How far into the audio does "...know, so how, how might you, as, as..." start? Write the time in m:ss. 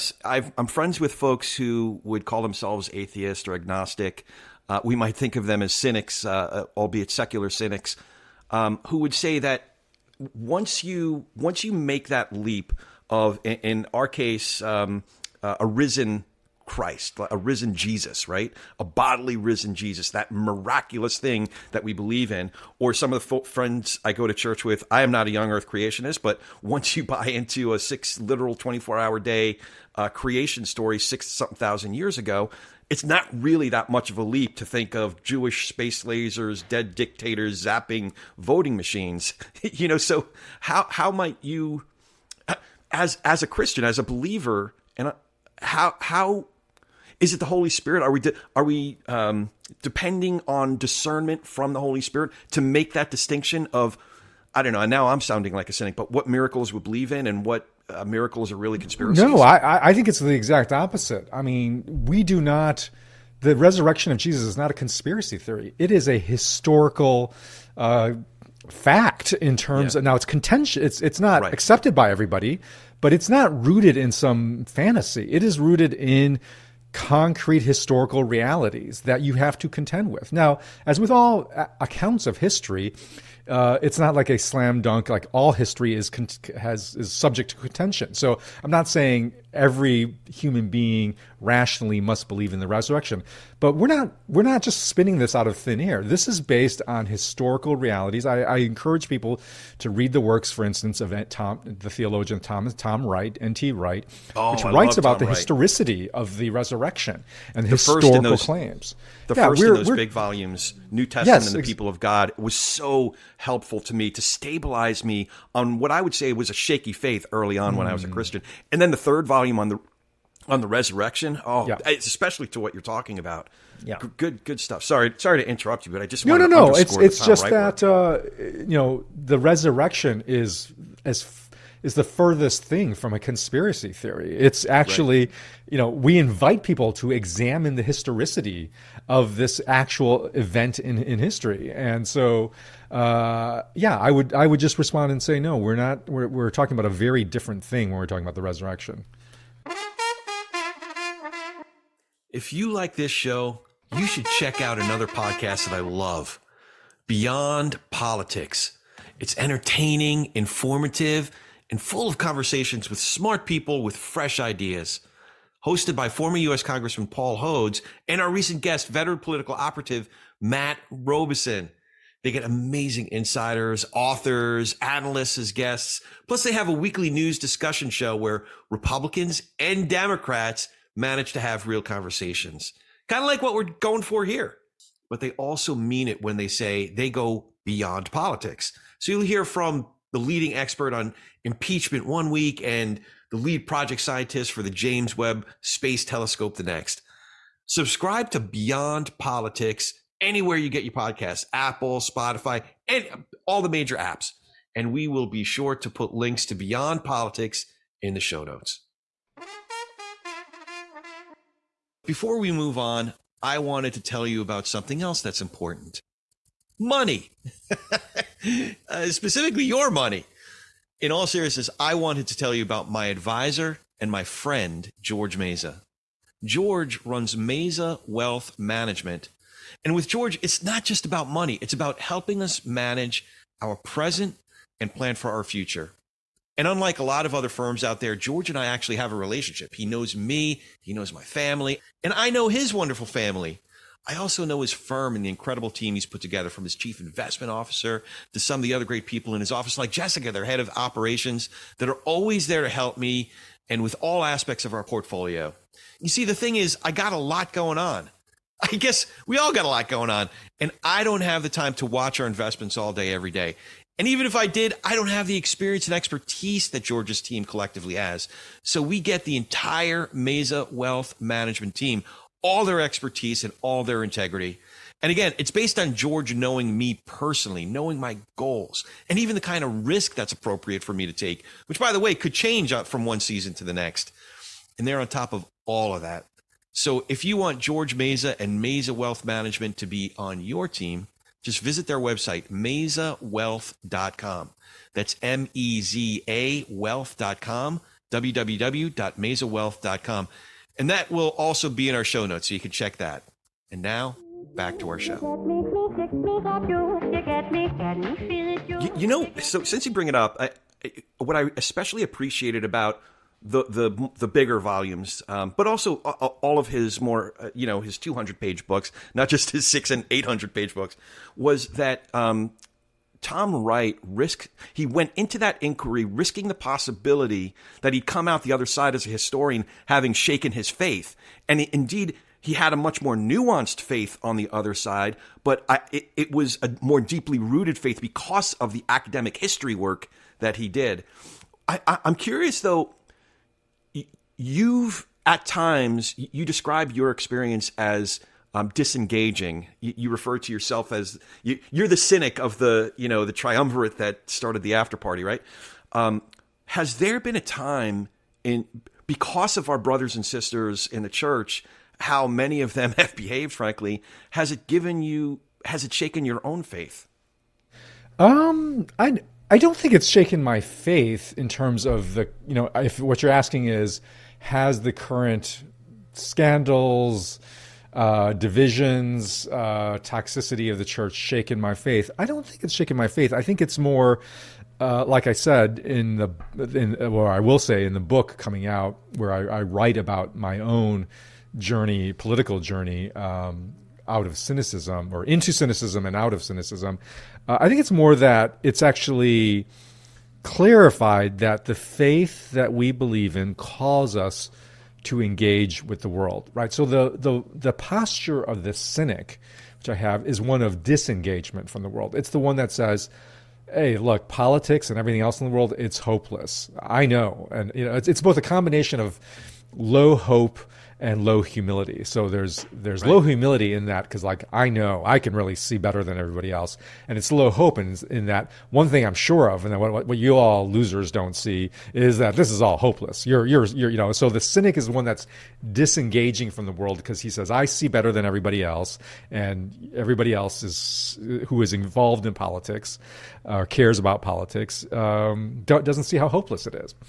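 0:39.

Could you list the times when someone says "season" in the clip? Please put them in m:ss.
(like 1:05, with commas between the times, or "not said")
4:43.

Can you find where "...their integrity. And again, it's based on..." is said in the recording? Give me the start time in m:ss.
4:33.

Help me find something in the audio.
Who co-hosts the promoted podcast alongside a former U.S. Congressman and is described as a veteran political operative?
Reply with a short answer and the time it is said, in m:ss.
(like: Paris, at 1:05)
Matt Robison, at 2:50.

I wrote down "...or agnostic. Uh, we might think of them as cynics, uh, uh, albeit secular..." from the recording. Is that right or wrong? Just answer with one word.
right.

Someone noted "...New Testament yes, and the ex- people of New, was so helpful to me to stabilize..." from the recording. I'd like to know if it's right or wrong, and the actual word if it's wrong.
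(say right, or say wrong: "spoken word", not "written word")
wrong: "God", not "New".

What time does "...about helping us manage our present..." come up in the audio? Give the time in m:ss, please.
3:51.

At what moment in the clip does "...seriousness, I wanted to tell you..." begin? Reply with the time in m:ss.
3:41.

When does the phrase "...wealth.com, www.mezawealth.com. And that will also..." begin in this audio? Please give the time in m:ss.
4:56.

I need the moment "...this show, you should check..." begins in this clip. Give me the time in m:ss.
2:32.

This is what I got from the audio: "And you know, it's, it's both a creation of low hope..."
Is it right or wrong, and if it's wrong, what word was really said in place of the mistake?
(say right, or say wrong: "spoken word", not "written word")
wrong: "combination", not "creation".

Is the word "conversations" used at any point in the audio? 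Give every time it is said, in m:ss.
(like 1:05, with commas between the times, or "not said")
2:42, 3:01.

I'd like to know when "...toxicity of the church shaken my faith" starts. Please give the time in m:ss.
6:20.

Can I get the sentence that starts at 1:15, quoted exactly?
It is rooted in concrete historical realities that you have to contend with.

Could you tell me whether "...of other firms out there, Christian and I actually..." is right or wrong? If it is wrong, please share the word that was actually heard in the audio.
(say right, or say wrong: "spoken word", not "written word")
wrong: "George", not "Christian".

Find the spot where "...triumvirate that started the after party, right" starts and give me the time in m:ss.
5:53.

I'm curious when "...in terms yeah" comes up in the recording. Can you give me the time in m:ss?
1:09.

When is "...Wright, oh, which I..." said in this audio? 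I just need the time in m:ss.
1:43.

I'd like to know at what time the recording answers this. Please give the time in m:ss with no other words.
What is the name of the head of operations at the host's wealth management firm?
4:09.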